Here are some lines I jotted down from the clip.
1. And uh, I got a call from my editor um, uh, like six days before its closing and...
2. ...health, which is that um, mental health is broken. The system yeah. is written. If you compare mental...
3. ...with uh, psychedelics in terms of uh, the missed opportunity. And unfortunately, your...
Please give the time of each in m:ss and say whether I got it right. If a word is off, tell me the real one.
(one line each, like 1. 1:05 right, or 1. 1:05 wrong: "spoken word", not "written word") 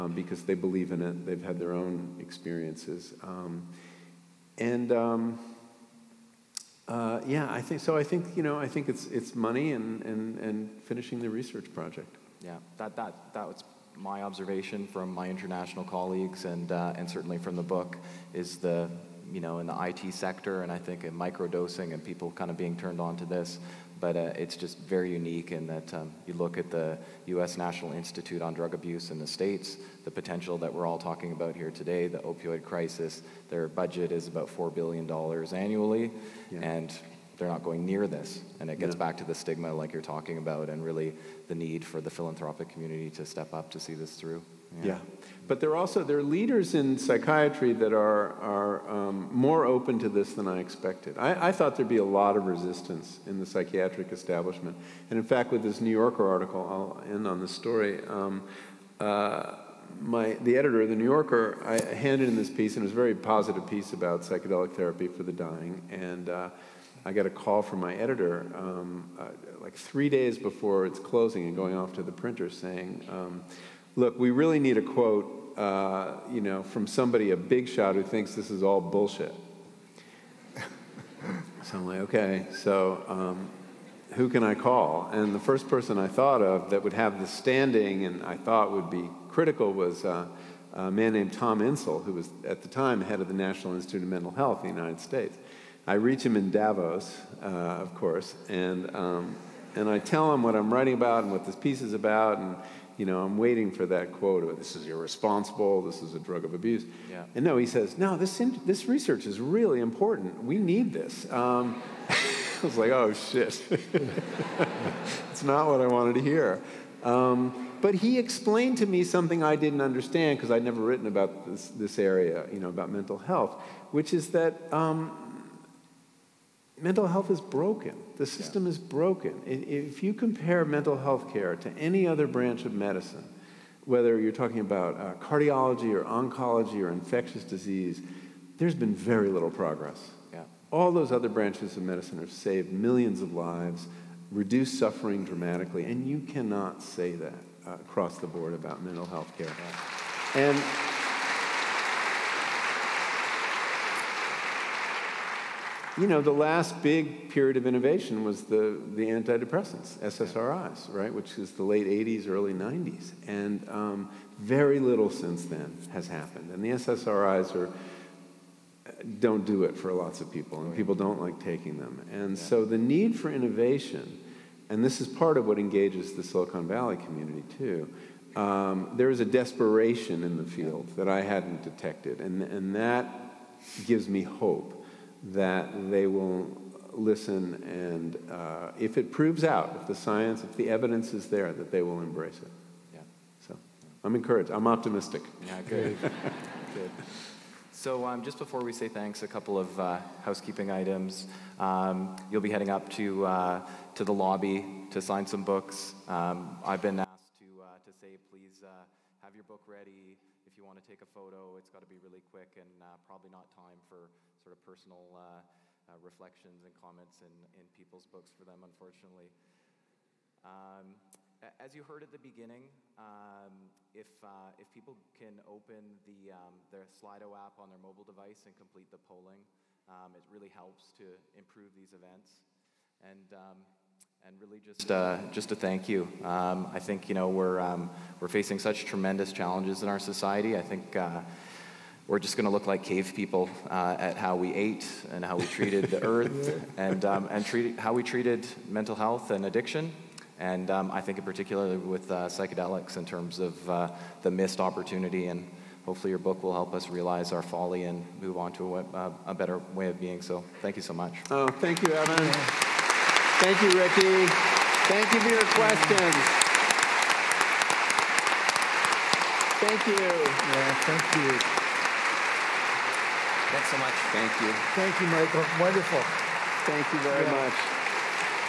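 1. 1:05 wrong: "three", not "six"
2. 2:03 wrong: "broken", not "written"
3. 4:11 wrong: "hopefully", not "unfortunately".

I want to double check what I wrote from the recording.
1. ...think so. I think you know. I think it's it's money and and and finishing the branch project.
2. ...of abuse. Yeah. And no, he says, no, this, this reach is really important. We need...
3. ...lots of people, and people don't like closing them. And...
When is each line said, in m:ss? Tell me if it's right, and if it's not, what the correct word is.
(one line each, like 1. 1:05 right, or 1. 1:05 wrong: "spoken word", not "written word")
1. 0:07 wrong: "research", not "branch"
2. 1:46 wrong: "research", not "reach"
3. 2:49 wrong: "taking", not "closing".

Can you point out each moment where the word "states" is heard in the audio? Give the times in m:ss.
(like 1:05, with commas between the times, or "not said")
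0:29, 1:35.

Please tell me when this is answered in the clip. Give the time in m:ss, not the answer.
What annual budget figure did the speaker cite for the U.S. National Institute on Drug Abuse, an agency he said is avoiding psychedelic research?
0:34.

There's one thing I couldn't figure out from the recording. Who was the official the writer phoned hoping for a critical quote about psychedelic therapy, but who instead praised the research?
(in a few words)
Tom Insel.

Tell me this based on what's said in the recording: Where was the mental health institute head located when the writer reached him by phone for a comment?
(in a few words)
Davos.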